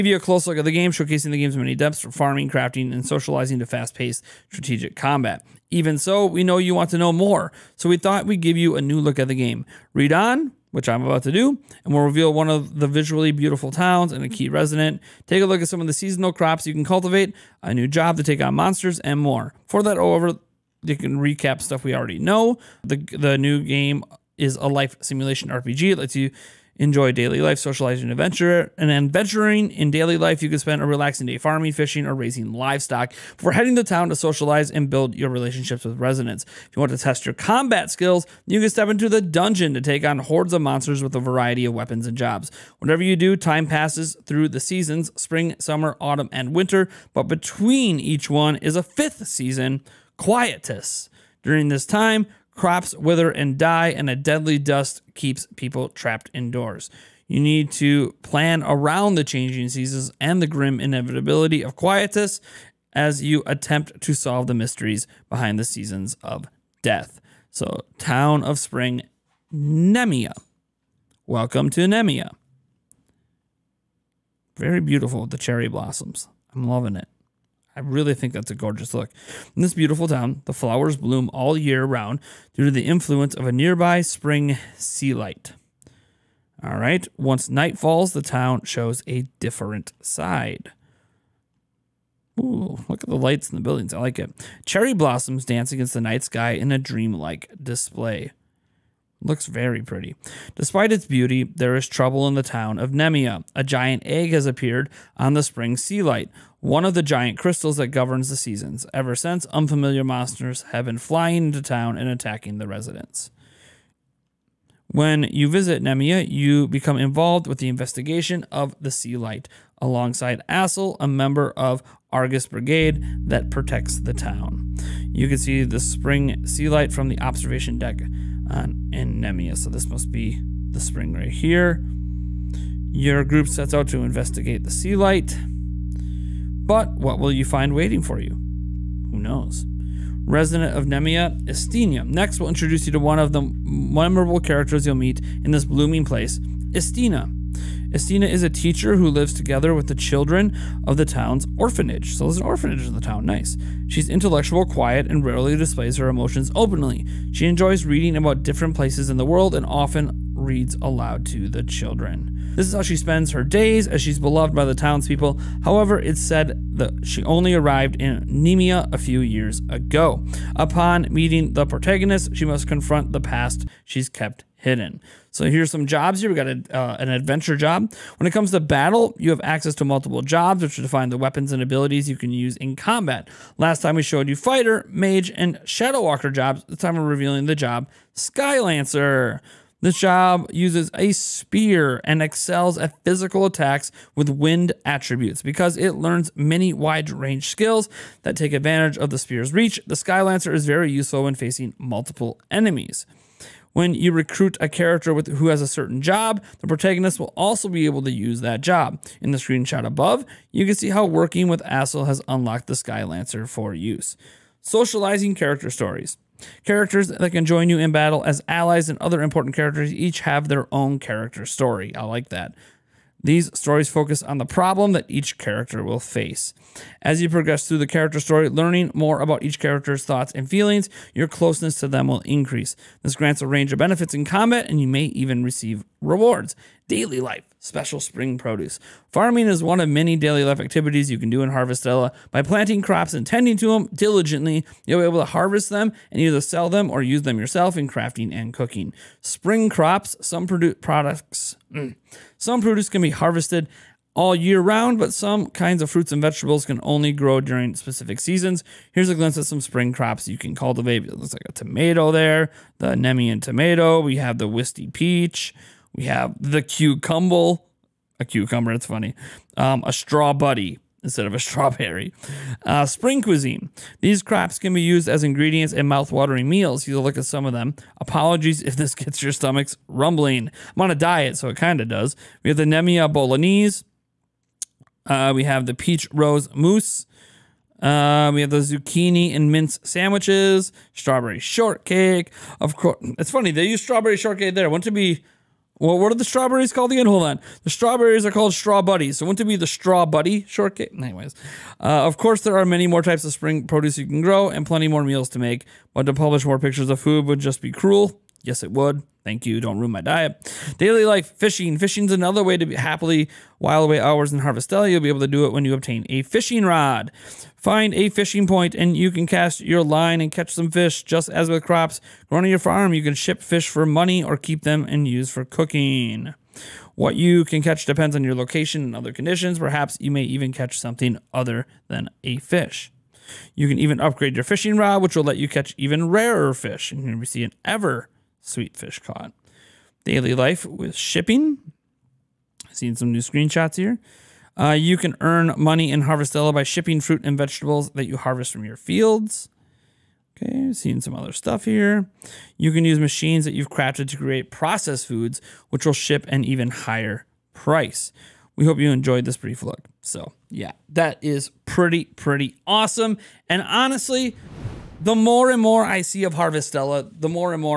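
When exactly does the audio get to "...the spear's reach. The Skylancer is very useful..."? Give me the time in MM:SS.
03:19.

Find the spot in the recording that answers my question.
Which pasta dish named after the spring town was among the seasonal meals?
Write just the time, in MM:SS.
04:42.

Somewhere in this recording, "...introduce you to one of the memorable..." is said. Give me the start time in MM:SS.
02:22.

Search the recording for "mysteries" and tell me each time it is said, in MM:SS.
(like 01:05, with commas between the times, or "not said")
01:04.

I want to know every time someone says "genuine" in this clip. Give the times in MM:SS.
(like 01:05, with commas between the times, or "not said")
not said.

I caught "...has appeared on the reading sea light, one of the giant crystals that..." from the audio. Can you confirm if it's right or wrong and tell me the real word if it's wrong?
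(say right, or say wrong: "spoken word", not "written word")
wrong: "spring", not "reading".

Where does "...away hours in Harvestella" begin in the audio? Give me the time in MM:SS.
05:13.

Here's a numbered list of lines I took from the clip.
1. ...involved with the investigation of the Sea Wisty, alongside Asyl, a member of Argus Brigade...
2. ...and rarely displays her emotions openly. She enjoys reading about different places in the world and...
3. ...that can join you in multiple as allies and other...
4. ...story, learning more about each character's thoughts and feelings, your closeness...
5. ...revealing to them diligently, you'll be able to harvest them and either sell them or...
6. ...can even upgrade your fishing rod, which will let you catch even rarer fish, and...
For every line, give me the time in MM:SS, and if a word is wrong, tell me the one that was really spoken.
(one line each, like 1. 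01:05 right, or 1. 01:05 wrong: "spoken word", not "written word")
1. 01:56 wrong: "Light", not "Wisty"
2. 02:35 right
3. 03:37 wrong: "battle", not "multiple"
4. 03:48 right
5. 04:03 wrong: "tending", not "revealing"
6. 05:33 right.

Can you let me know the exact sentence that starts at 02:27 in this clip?
Istina is a teacher who lives together with the children of the town's orphanage.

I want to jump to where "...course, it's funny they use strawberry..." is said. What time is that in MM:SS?
04:52.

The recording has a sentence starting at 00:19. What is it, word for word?
For that, over you can recap stuff we already know.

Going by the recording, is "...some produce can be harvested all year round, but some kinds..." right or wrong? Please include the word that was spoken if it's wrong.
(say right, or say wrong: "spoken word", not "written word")
right.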